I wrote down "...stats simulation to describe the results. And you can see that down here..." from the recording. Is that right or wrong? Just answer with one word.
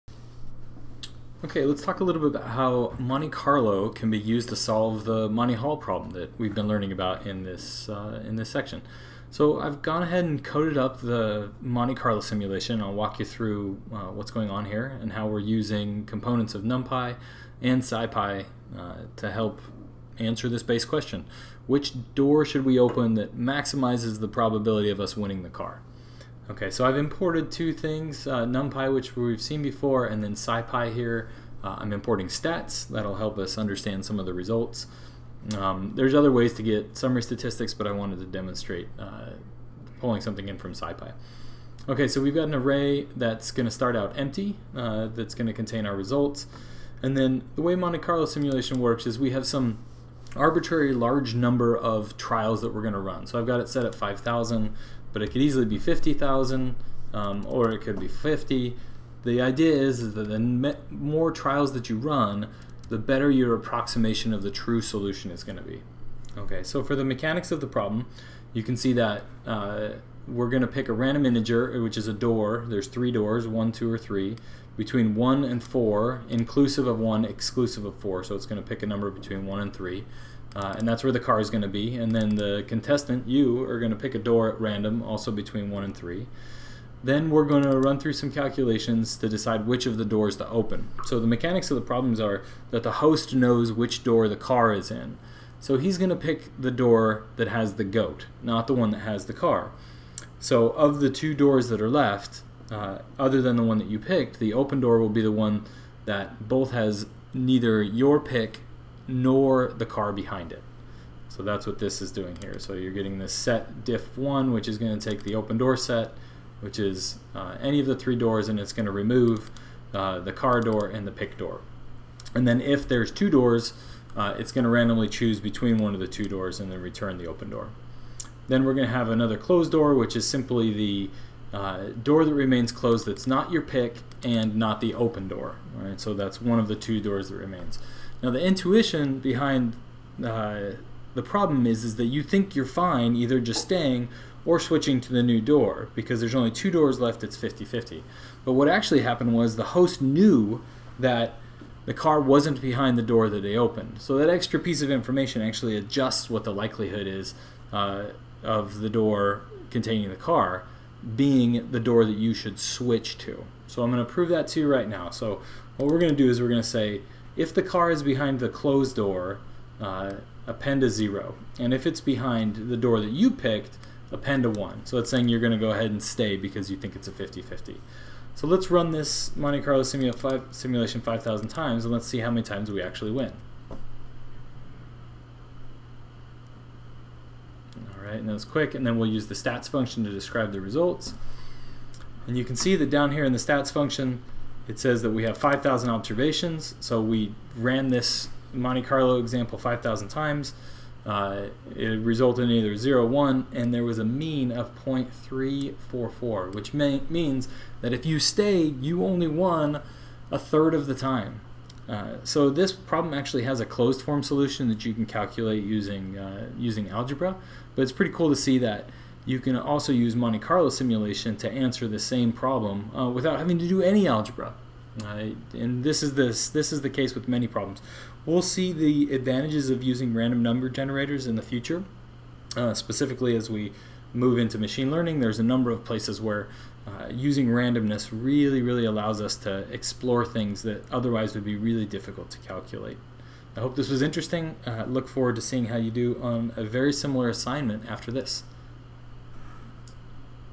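wrong.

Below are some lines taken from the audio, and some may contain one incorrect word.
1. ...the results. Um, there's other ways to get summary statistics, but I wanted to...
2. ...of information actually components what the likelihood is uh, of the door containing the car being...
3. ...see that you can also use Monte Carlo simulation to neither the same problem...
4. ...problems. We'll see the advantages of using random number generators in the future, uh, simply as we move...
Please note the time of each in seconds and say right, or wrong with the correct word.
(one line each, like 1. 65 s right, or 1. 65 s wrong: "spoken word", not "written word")
1. 34 s right
2. 154 s wrong: "adjusts", not "components"
3. 218 s wrong: "answer", not "neither"
4. 227 s wrong: "specifically", not "simply".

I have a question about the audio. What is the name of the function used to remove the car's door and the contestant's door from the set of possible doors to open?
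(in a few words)
setdiff1d.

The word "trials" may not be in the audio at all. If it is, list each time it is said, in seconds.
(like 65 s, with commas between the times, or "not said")
52 s, 61 s.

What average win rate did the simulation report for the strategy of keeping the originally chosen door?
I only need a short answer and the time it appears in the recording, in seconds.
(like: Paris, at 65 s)
0.344, at 204 s.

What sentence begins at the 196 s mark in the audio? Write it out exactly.
So we ran this Monte Carlo example 5,000 times.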